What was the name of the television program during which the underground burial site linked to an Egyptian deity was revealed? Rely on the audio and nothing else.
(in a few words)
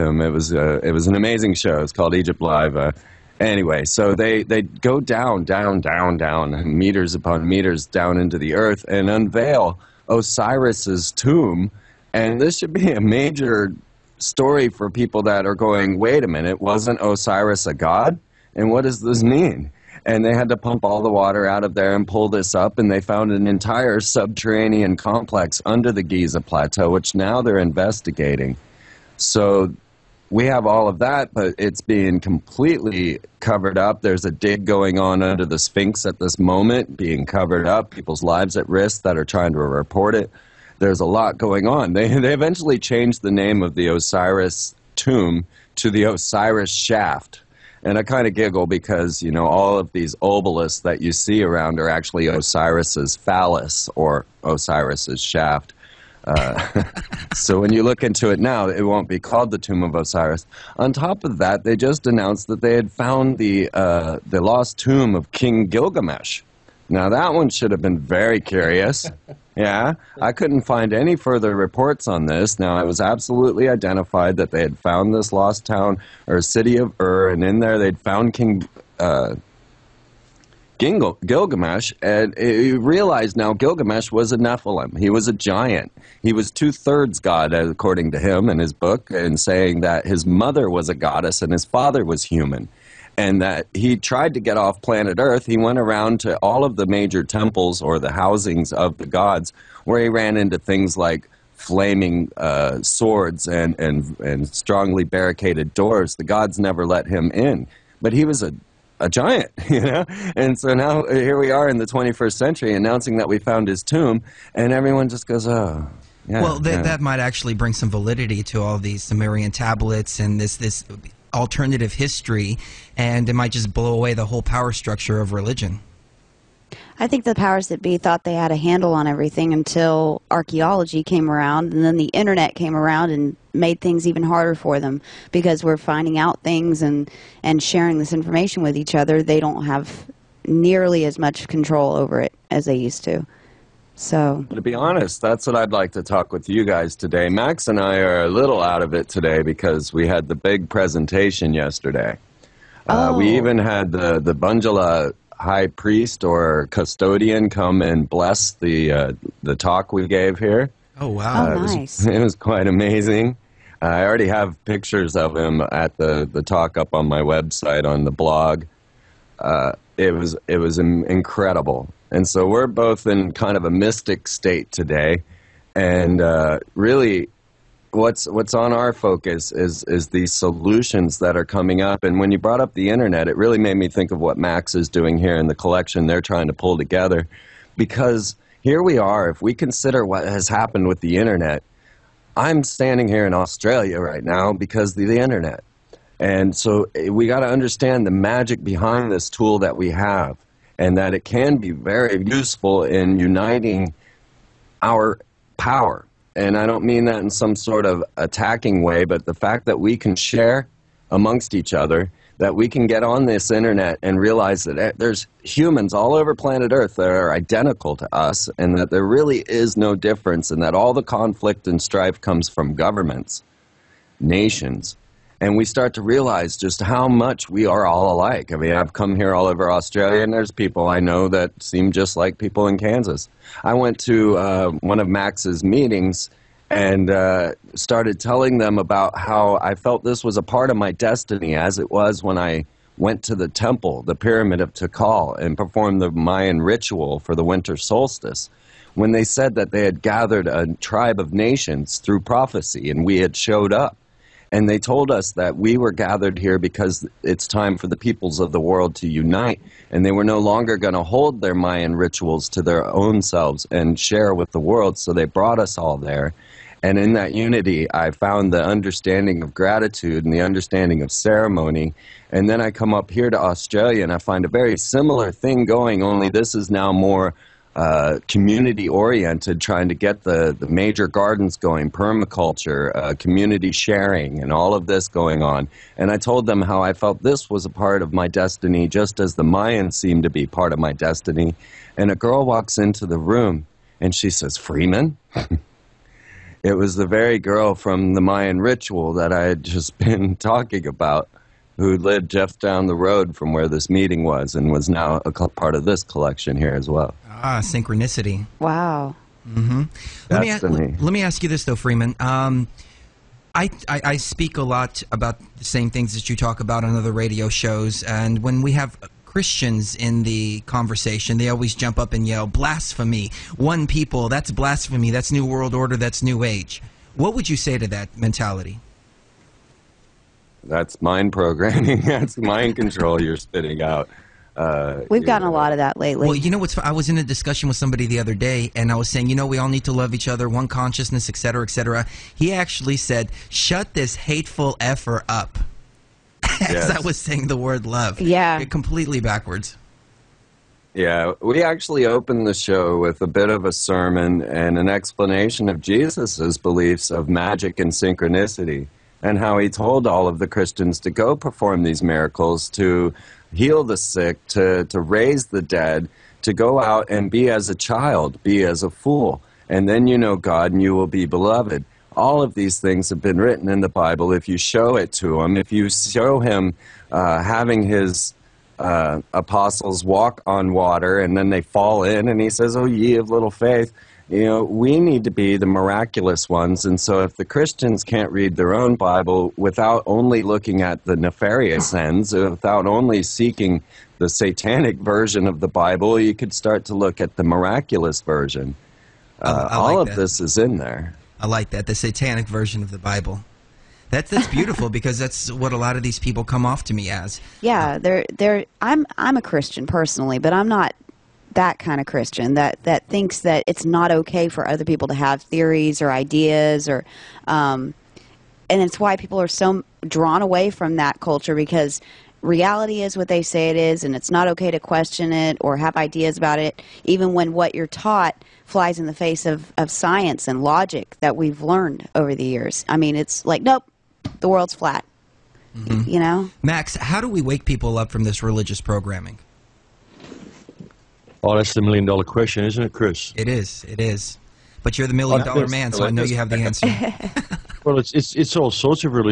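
Egypt Live.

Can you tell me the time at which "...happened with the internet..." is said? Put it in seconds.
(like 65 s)
190 s.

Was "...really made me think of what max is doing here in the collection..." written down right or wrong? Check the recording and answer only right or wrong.
right.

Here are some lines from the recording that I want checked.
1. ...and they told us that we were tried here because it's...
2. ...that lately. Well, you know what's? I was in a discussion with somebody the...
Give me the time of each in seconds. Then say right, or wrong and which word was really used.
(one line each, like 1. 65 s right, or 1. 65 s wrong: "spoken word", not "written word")
1. 254 s wrong: "gathered", not "tried"
2. 335 s right.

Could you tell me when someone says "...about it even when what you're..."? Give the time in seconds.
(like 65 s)
426 s.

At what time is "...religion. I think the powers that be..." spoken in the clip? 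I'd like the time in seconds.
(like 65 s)
125 s.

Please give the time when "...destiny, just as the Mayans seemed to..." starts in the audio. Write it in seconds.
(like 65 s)
288 s.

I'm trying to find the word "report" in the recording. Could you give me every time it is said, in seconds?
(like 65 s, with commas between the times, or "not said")
39 s, 71 s.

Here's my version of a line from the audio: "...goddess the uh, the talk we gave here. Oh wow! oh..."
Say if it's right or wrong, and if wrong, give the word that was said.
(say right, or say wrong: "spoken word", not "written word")
wrong: "bless", not "goddess".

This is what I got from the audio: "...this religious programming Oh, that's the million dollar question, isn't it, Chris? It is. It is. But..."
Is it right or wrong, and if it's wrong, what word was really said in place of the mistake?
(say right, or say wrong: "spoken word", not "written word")
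right.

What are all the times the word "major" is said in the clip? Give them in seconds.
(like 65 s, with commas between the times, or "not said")
13 s, 96 s, 280 s.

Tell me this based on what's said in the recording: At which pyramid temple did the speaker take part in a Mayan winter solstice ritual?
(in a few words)
Tikal.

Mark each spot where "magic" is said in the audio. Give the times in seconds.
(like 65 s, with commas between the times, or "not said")
198 s, 357 s.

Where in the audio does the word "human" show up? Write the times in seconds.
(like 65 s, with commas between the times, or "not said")
92 s, 215 s.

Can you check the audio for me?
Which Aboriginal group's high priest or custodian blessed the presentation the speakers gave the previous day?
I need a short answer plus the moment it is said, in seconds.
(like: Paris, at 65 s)
Bundjalung, at 154 s.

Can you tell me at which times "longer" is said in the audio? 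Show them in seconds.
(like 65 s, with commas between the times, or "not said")
260 s.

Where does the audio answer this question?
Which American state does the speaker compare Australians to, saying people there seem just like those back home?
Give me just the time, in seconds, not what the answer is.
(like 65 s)
232 s.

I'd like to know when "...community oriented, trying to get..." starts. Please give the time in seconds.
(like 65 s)
278 s.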